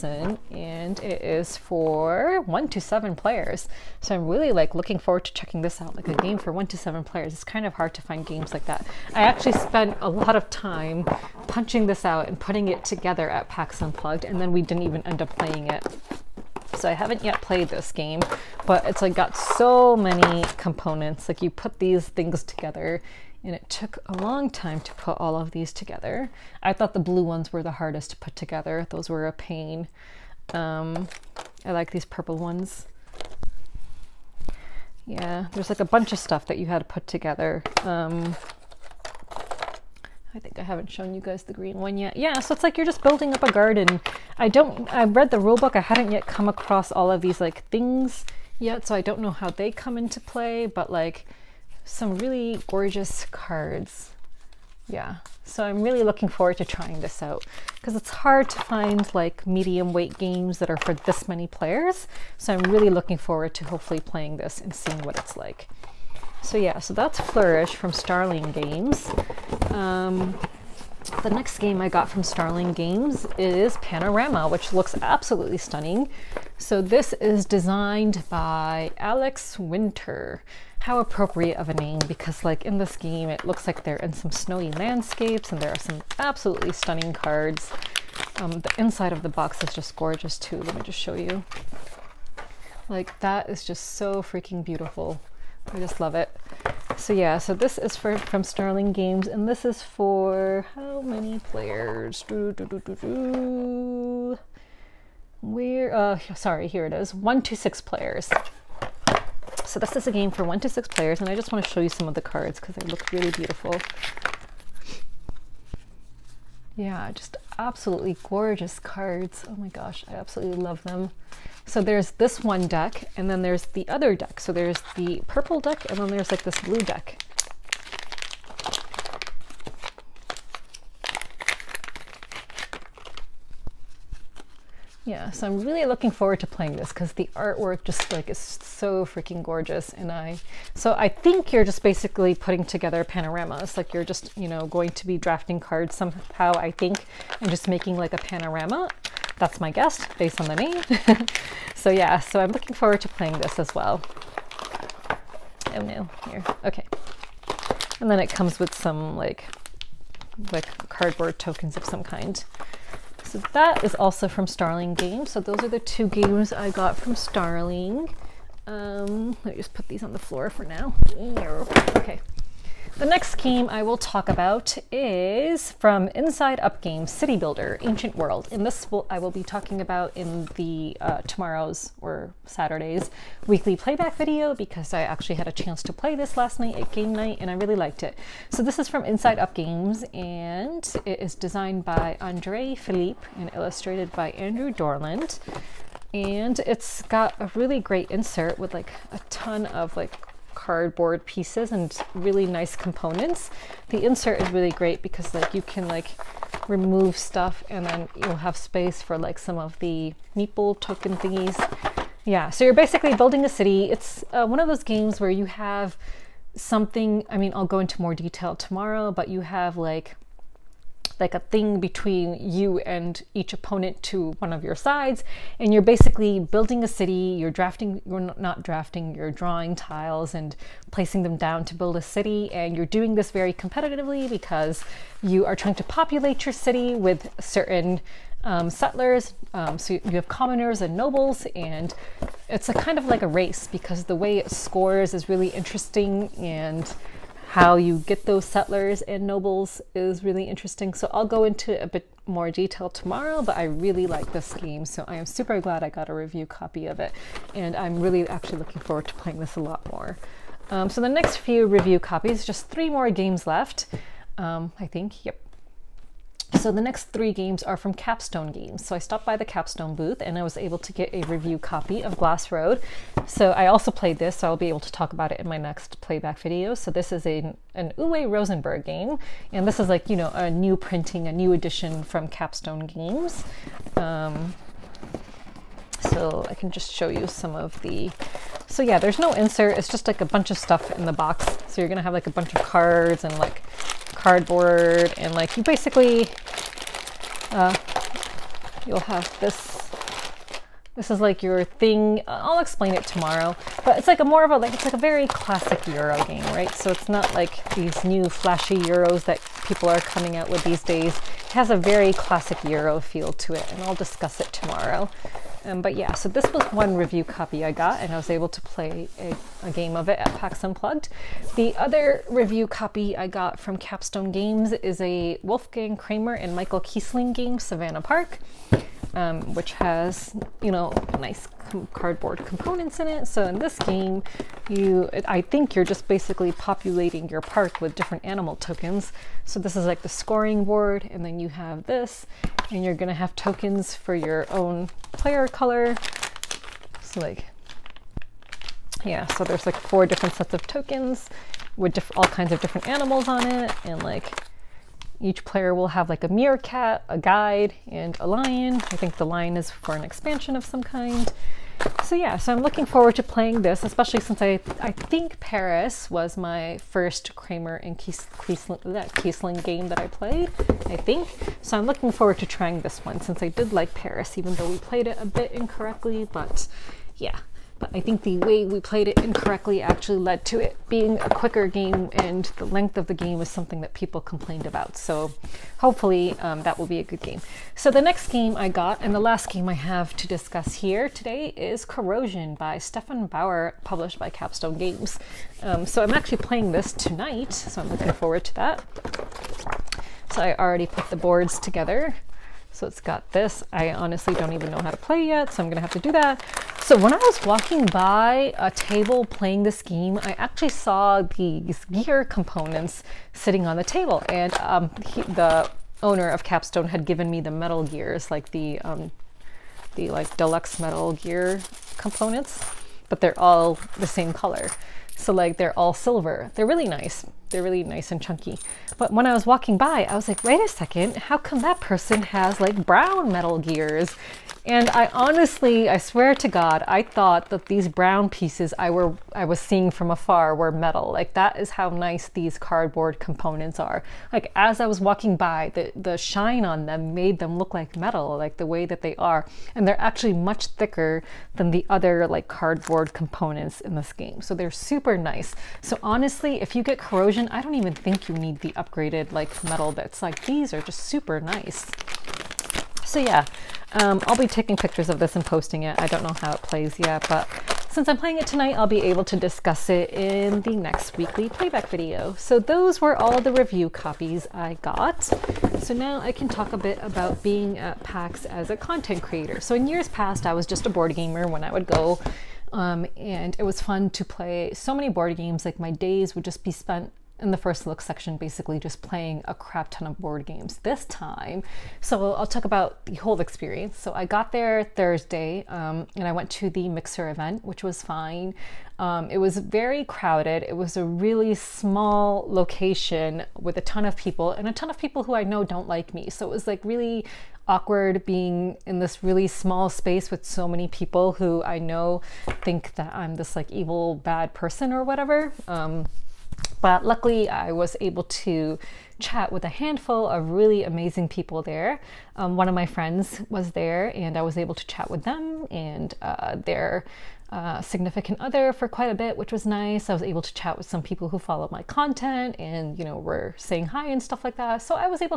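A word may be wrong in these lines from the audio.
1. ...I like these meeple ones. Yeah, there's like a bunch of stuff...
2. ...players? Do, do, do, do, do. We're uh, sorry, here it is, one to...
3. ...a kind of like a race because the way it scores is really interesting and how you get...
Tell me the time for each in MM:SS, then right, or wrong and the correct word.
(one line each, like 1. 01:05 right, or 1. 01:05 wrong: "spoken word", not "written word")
1. 00:31 wrong: "purple", not "meeple"
2. 01:41 right
3. 04:02 right.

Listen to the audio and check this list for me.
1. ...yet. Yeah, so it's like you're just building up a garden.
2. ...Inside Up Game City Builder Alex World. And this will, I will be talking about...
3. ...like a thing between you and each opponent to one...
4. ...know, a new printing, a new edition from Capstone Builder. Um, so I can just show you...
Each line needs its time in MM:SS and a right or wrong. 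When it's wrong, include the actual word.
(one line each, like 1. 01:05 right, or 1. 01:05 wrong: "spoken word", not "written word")
1. 00:41 right
2. 02:56 wrong: "Ancient", not "Alex"
3. 03:41 right
4. 04:40 wrong: "Games", not "Builder".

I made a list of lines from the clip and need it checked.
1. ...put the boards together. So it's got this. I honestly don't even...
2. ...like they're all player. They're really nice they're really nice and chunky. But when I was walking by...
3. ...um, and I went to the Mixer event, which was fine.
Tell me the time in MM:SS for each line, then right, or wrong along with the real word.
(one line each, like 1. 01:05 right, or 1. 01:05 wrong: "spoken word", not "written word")
1. 06:40 right
2. 07:05 wrong: "silver", not "player"
3. 08:15 right.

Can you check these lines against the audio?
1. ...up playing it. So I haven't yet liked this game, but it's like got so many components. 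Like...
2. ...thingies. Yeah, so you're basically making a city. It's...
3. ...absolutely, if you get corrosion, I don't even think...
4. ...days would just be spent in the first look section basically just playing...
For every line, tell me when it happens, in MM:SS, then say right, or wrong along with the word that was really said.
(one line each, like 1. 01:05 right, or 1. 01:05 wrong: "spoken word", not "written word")
1. 00:15 wrong: "played", not "liked"
2. 03:31 wrong: "building", not "making"
3. 07:36 wrong: "honestly", not "absolutely"
4. 08:05 right.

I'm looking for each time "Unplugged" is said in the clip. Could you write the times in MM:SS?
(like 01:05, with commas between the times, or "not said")
00:13, 05:20.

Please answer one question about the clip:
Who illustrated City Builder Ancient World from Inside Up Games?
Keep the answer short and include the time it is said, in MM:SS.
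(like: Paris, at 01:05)
Andrew Dorland, at 03:14.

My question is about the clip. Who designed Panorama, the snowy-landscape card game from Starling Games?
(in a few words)
Alex Winter.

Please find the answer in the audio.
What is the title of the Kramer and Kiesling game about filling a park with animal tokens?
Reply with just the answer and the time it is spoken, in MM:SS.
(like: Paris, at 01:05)
Savannah Park, at 05:27.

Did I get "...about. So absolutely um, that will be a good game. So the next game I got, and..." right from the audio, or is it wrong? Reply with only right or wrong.
wrong.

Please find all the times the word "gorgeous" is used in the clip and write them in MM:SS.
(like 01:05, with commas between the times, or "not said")
00:52, 01:29, 01:58, 02:19.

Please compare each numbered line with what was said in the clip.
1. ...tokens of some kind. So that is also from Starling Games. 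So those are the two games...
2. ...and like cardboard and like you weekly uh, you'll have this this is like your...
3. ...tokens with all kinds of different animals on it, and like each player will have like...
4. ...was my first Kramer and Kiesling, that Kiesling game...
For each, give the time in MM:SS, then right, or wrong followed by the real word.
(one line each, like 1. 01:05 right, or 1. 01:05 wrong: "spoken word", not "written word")
1. 02:41 right
2. 04:53 wrong: "basically", not "weekly"
3. 05:50 right
4. 06:06 right.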